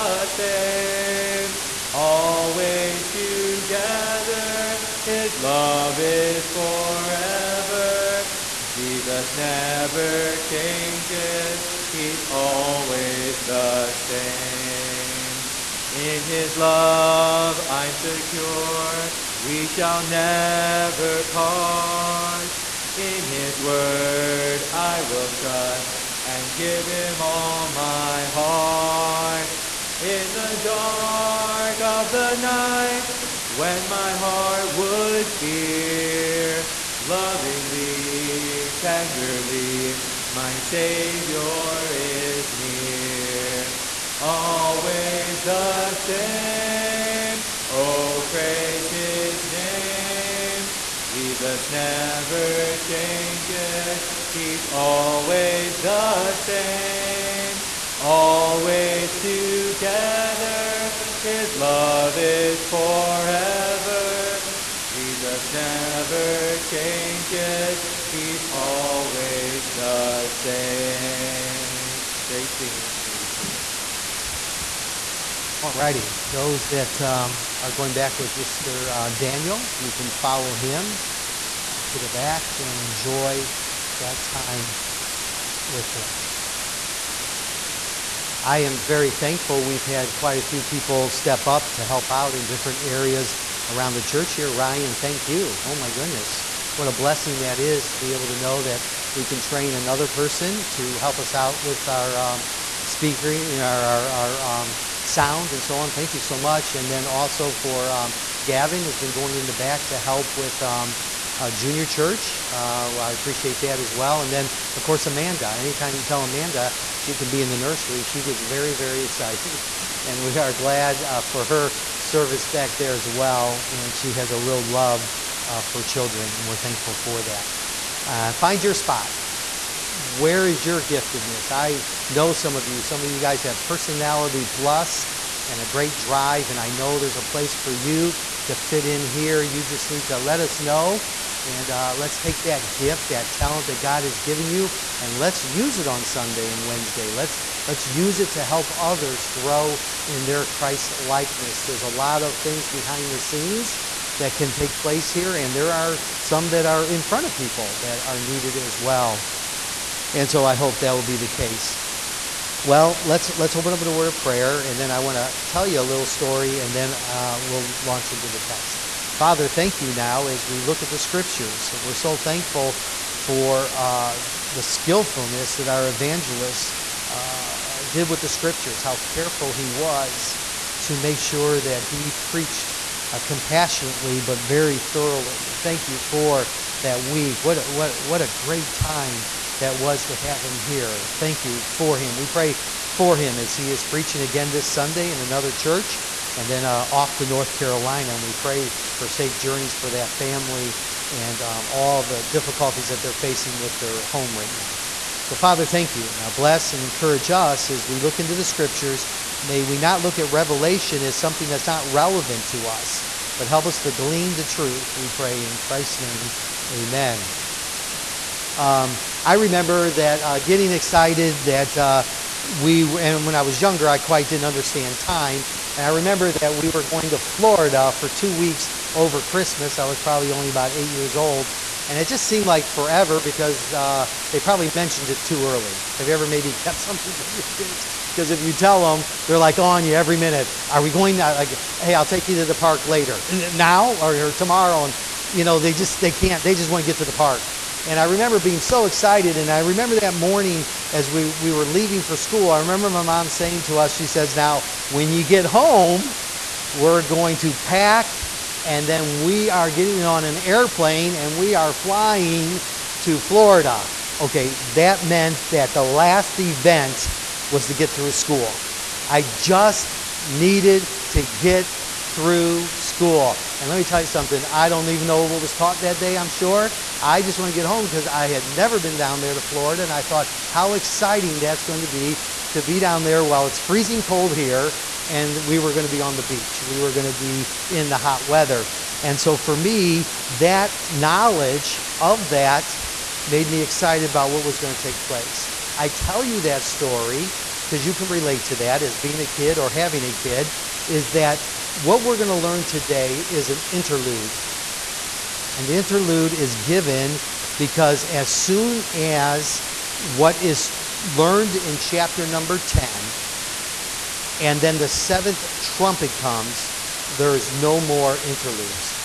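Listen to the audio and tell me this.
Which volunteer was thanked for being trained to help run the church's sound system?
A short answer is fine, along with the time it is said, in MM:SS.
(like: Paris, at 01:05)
Ryan, at 01:34.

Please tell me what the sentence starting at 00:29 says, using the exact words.
In the dark of the night, when my heart would fear, lovingly, tenderly, my Savior is near.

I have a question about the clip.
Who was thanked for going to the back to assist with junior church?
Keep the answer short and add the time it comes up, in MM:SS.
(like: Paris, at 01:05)
Gavin, at 01:48.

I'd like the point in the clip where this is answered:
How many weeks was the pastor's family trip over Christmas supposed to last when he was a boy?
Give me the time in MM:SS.
03:48.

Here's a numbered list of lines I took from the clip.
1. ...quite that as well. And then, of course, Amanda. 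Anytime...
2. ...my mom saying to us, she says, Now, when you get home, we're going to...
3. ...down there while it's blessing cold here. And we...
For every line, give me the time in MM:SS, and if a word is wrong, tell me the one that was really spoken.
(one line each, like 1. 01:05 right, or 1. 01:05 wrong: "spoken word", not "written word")
1. 01:53 wrong: "appreciate", not "quite"
2. 04:12 right
3. 04:42 wrong: "freezing", not "blessing".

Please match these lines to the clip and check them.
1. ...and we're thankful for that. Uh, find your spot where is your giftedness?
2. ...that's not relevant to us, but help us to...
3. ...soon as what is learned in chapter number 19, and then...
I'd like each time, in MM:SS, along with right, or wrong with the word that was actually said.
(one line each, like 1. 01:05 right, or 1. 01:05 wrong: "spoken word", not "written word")
1. 02:06 right
2. 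03:31 right
3. 05:08 wrong: "10", not "19".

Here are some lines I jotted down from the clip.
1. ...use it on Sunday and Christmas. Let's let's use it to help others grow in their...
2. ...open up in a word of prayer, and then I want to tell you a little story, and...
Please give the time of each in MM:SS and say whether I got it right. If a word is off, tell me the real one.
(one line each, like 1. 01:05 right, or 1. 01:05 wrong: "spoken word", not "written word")
1. 02:25 wrong: "Wednesday", not "Christmas"
2. 02:43 right.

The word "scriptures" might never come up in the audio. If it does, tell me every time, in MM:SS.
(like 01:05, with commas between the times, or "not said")
02:50, 02:58, 03:28.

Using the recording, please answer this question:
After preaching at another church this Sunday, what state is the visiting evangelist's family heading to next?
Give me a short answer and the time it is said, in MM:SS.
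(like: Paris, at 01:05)
North Carolina, at 03:17.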